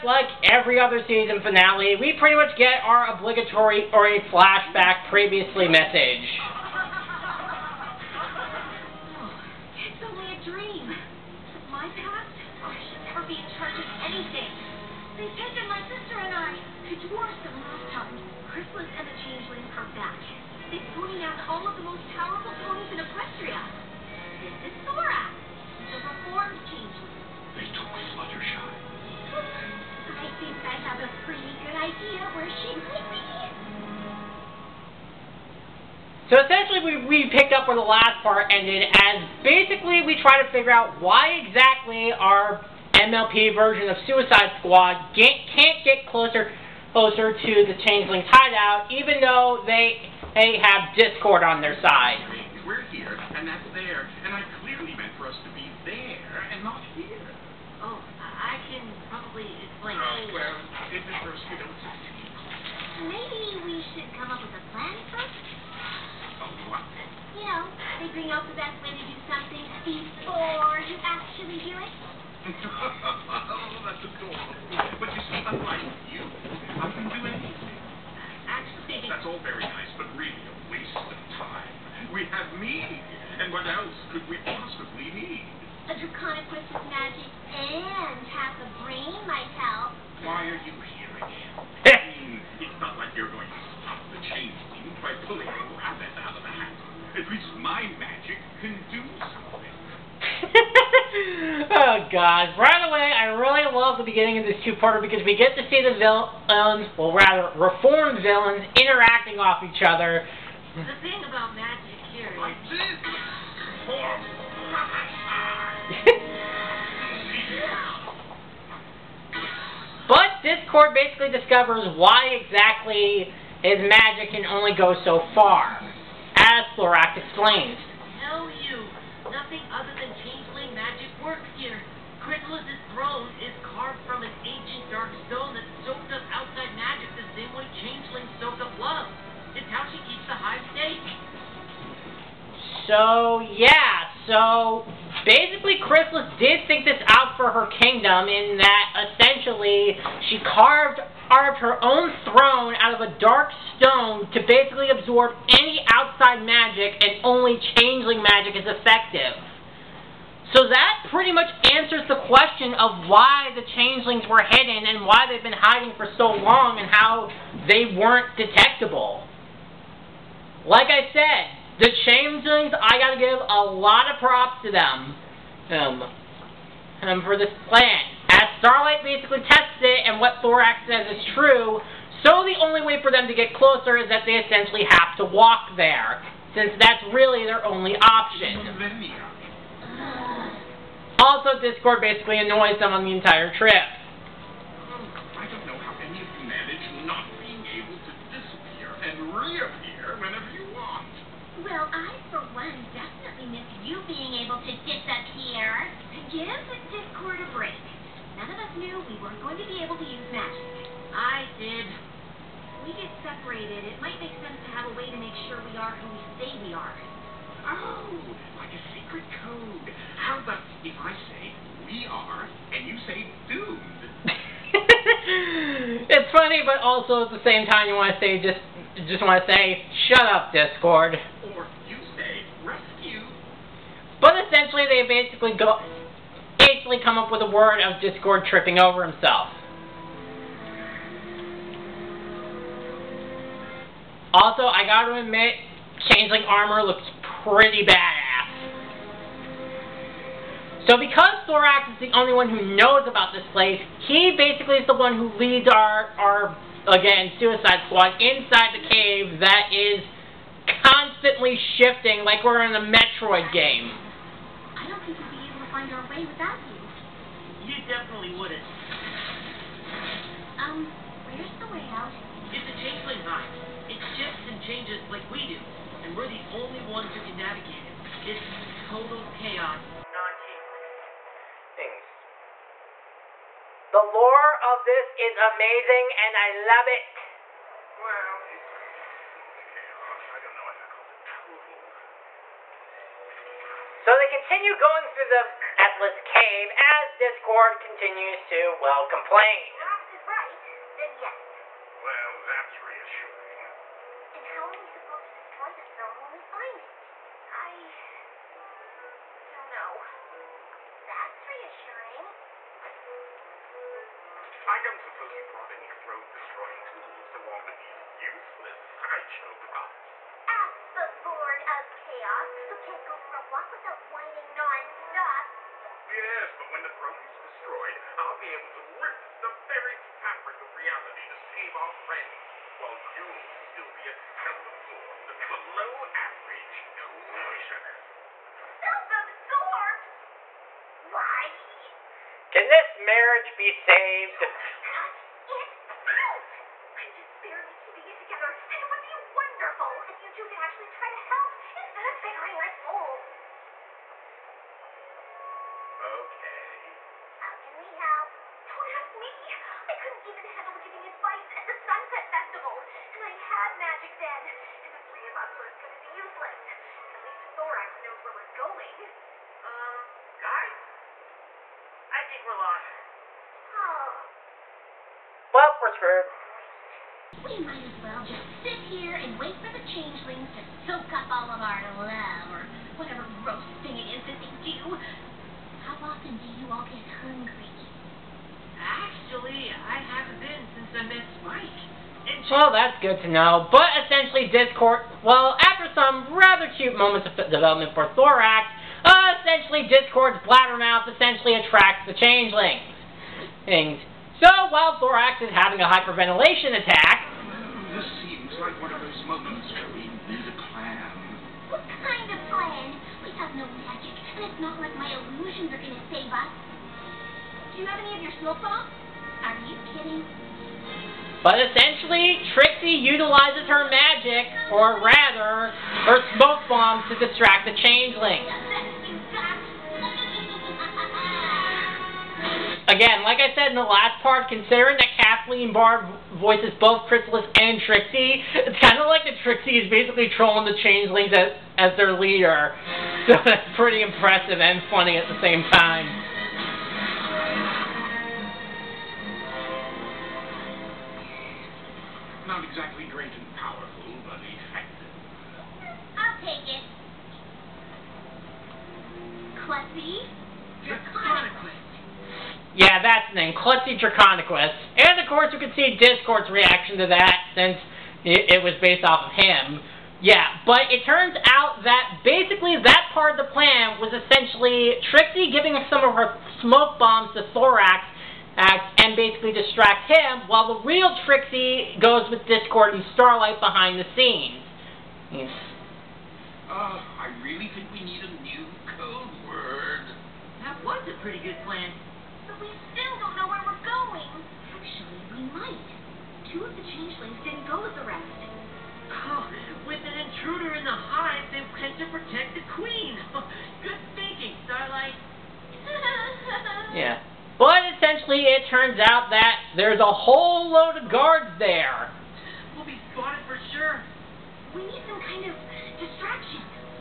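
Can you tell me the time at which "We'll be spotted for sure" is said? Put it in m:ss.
8:32.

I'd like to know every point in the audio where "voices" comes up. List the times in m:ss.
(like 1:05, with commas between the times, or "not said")
7:16.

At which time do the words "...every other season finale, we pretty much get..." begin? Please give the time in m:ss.
0:00.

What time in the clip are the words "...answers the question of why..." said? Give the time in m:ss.
2:41.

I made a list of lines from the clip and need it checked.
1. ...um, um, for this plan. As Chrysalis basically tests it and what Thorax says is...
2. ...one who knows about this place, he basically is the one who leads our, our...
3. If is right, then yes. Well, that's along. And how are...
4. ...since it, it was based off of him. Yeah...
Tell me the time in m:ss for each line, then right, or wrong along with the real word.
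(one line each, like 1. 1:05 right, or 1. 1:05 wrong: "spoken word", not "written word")
1. 2:55 wrong: "Starlight", not "Chrysalis"
2. 4:12 right
3. 4:59 wrong: "reassuring", not "along"
4. 7:47 right.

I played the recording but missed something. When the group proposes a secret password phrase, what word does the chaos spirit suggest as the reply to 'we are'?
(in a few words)
doomed.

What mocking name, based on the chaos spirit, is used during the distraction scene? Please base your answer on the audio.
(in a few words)
Klutzy Draconequus.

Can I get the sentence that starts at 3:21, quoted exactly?
Well, I, for one, definitely miss you being able to disappear.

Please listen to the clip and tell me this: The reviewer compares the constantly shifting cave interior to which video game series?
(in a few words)
Metroid.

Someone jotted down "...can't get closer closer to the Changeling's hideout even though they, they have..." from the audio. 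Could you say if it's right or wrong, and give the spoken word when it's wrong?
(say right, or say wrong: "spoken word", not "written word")
right.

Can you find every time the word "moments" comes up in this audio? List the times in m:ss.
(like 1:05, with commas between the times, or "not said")
6:36, 6:49.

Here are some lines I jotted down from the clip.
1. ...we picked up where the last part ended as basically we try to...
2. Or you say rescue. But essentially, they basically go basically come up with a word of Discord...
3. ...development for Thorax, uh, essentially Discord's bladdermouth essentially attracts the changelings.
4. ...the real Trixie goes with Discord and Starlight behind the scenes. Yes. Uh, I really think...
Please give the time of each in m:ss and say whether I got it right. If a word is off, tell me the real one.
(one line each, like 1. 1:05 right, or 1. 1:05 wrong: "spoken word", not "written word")
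1. 0:37 right
2. 3:51 right
3. 6:37 right
4. 8:00 right.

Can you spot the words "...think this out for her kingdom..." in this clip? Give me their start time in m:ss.
2:26.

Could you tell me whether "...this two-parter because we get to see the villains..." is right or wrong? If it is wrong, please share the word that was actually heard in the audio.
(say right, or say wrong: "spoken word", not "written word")
right.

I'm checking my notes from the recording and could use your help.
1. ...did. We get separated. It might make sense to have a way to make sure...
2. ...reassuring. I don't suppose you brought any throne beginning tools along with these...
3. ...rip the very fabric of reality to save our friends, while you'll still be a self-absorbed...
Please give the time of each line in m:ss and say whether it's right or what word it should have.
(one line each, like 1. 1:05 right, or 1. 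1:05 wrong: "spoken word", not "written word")
1. 3:31 right
2. 5:11 wrong: "destroying", not "beginning"
3. 5:29 right.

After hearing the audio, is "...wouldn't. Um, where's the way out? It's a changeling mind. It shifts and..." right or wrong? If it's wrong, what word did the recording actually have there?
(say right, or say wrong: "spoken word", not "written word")
right.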